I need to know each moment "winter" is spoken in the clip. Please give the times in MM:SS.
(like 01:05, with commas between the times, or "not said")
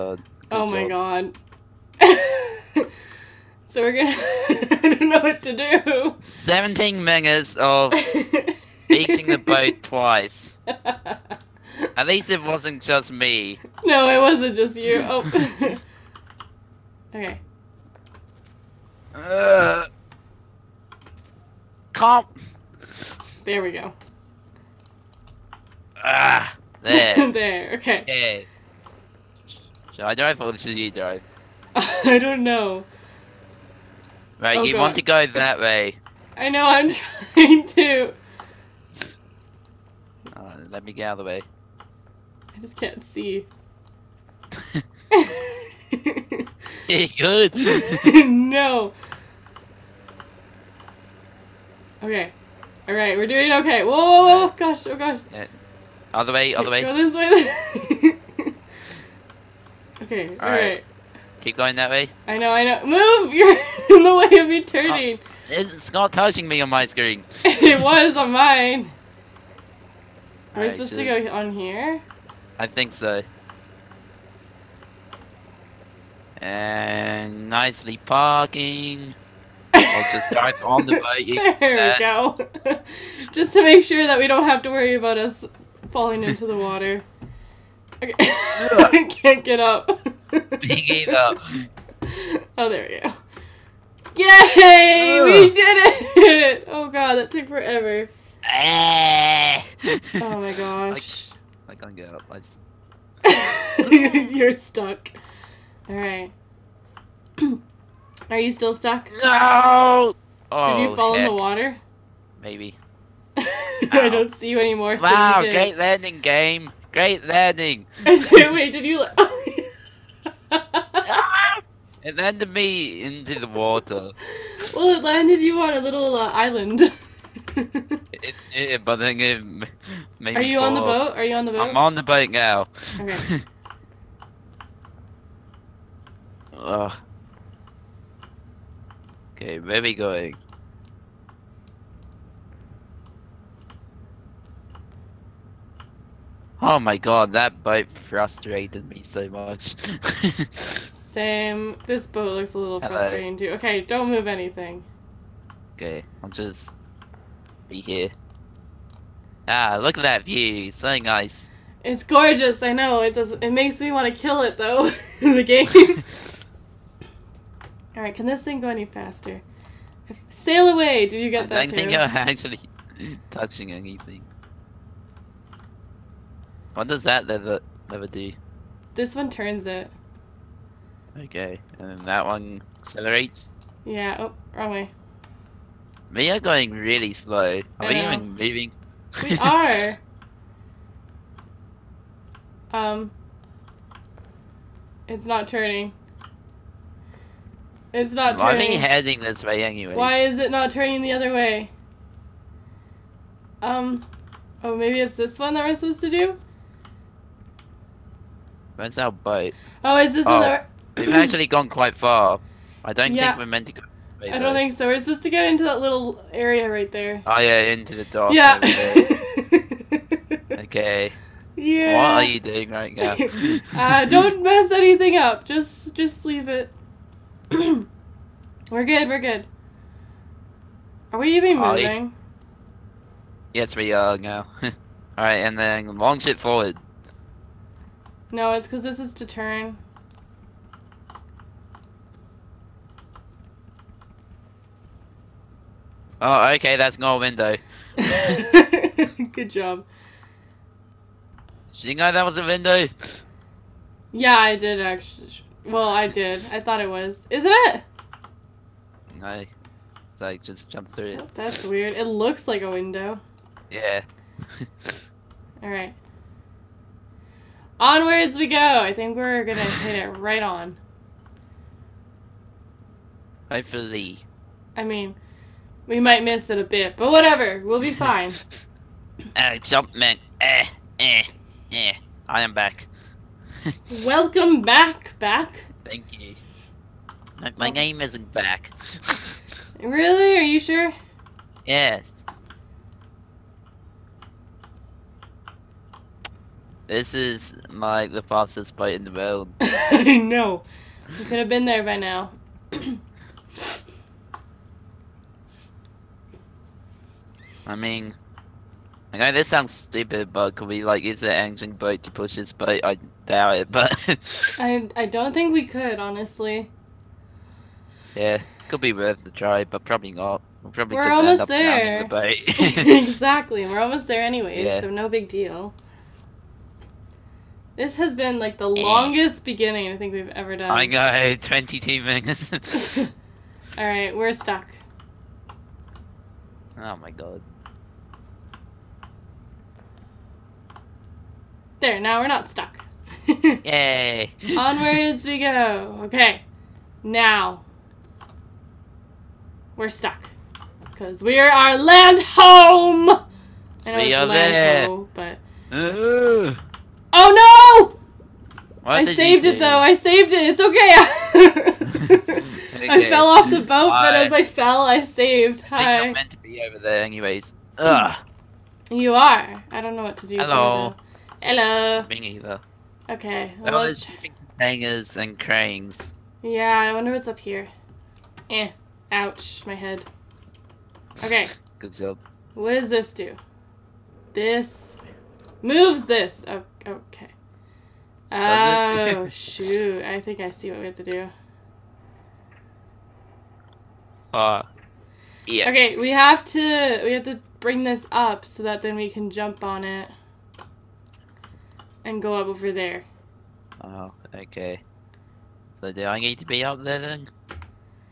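not said.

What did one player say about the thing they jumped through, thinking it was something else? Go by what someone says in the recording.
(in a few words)
that's not a window.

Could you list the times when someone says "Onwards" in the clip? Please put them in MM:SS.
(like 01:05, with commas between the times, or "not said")
04:27, 05:44.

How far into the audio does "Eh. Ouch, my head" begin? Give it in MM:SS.
06:18.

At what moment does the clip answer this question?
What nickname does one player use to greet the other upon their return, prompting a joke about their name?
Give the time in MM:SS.
04:39.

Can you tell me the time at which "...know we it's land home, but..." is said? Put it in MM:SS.
05:53.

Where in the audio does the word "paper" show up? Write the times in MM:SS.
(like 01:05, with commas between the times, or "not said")
not said.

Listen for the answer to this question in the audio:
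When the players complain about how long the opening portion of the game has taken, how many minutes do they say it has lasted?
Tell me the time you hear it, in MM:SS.
05:31.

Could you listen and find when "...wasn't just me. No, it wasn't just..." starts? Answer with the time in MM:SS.
00:12.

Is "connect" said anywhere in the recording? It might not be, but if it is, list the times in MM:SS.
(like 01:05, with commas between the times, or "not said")
not said.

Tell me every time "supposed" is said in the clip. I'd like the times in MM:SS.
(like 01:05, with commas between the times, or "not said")
01:10, 03:25, 03:34.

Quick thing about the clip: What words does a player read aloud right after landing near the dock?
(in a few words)
bangers hangers and cranes.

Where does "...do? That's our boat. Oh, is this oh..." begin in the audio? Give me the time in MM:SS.
03:26.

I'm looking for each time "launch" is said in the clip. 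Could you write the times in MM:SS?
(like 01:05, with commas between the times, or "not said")
03:55.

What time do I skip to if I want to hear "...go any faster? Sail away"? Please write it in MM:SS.
02:48.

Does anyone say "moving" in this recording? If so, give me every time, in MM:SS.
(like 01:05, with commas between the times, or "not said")
03:08, 03:51.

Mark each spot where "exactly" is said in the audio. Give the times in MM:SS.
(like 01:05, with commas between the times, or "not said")
05:23.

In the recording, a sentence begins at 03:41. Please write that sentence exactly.
What are you doing right now?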